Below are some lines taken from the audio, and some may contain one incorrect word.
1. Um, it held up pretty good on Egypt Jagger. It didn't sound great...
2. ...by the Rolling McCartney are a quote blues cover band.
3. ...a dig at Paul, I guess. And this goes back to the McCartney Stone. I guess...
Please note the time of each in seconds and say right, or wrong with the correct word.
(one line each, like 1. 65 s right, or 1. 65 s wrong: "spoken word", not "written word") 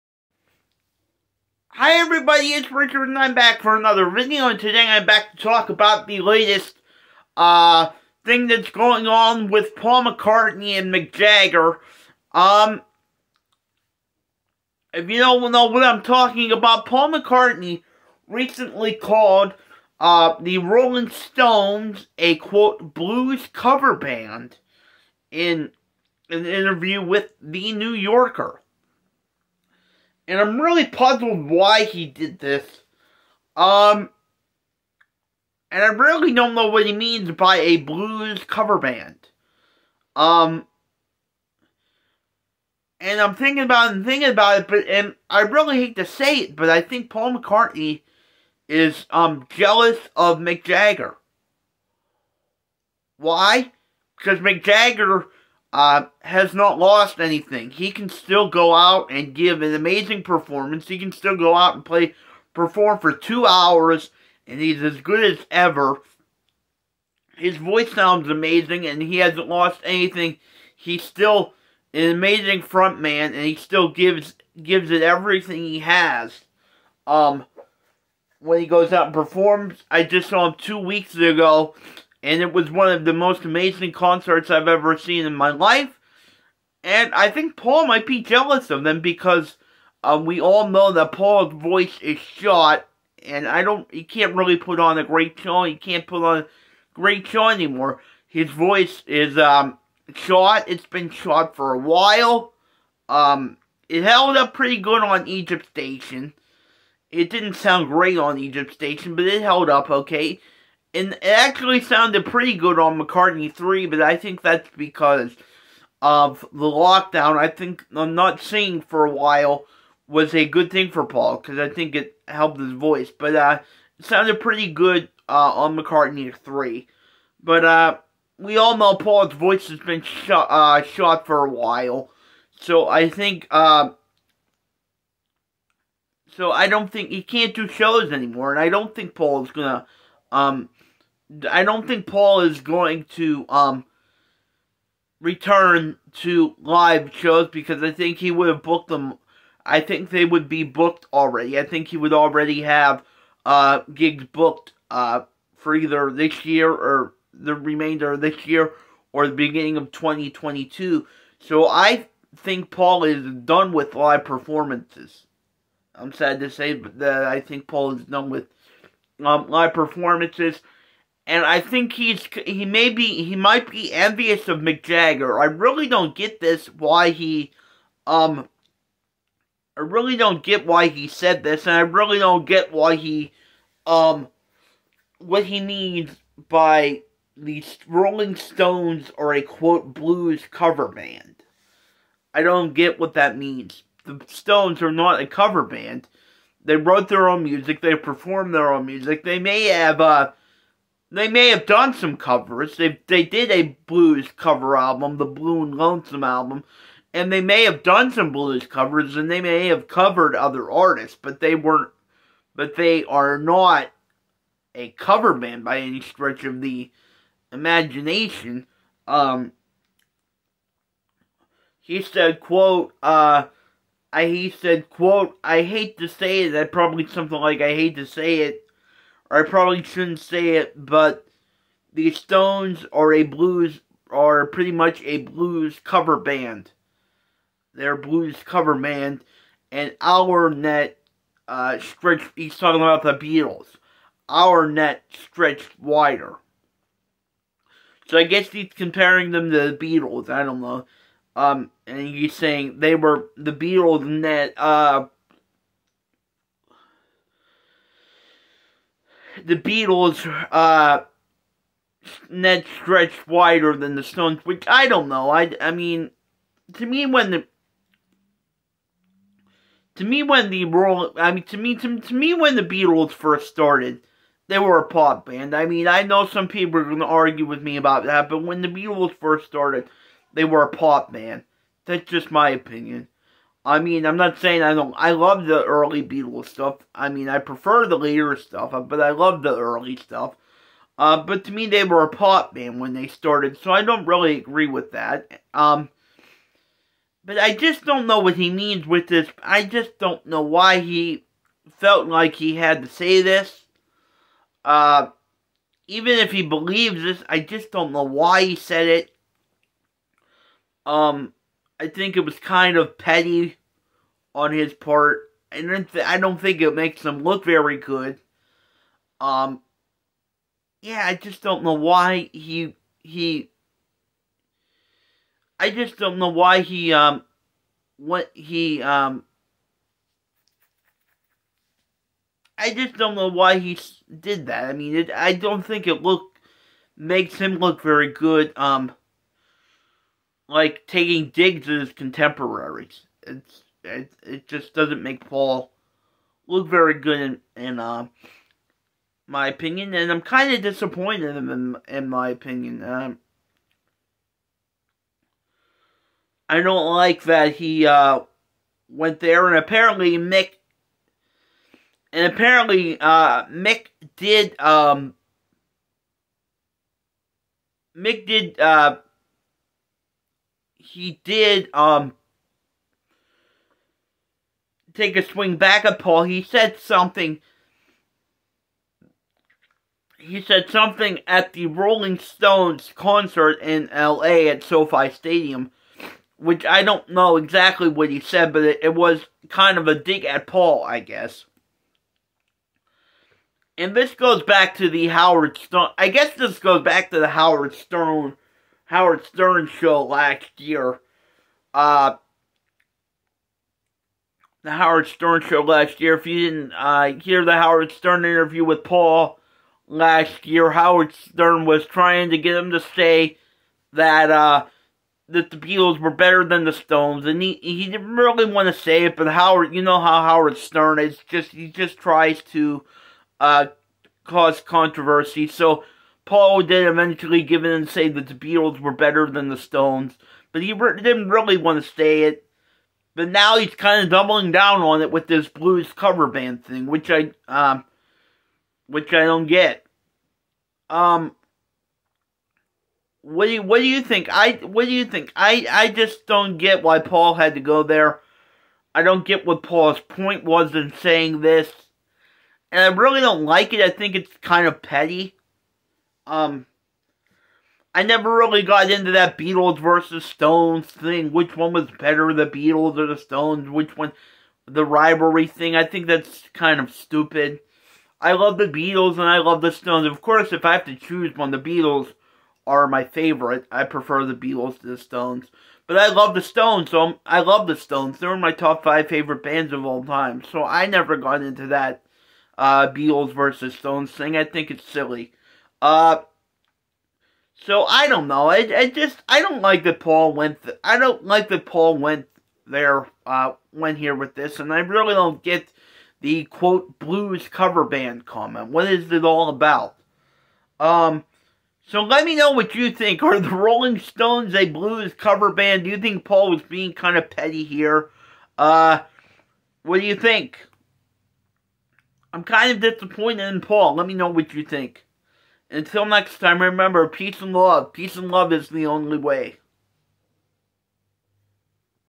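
1. 103 s wrong: "Station", not "Jagger"
2. 186 s wrong: "Stones", not "McCartney"
3. 389 s wrong: "Howard", not "McCartney".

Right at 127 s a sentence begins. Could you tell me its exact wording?
But uh, we all know Paul's voice has been shot, uh, shot for a while.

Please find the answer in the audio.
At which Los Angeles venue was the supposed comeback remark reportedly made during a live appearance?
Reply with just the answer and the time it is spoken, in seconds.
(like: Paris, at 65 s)
SoFi Stadium, at 384 s.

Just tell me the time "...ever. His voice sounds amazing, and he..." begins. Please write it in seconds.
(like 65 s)
65 s.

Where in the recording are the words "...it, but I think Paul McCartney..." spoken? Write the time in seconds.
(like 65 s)
46 s.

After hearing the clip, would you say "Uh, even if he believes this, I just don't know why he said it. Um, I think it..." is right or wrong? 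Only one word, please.
right.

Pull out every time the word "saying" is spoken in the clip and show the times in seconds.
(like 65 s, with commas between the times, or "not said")
252 s, 284 s, 451 s.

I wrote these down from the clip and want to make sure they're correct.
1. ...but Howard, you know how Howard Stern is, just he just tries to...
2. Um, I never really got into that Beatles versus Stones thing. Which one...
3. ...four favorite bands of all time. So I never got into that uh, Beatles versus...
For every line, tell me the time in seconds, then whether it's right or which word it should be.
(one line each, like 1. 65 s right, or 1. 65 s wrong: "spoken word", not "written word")
1. 419 s right
2. 456 s right
3. 478 s wrong: "five", not "four".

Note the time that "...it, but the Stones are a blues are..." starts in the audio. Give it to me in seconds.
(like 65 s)
230 s.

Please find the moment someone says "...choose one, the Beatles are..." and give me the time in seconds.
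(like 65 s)
470 s.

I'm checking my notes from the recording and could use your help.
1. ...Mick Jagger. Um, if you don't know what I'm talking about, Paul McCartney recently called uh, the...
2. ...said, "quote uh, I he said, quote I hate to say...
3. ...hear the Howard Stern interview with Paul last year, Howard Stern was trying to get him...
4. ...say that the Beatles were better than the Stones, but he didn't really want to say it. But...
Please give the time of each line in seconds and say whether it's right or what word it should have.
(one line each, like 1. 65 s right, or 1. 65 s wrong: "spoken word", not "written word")
1. 10 s right
2. 222 s right
3. 407 s right
4. 427 s right.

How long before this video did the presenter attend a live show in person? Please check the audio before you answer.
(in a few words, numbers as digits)
2 weeks ago.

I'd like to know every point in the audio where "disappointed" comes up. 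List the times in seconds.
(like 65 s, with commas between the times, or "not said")
350 s, 512 s.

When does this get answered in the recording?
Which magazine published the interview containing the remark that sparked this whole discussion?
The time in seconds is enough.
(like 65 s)
27 s.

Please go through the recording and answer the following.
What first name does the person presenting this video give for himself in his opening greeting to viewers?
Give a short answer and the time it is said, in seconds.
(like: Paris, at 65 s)
Richard, at 2 s.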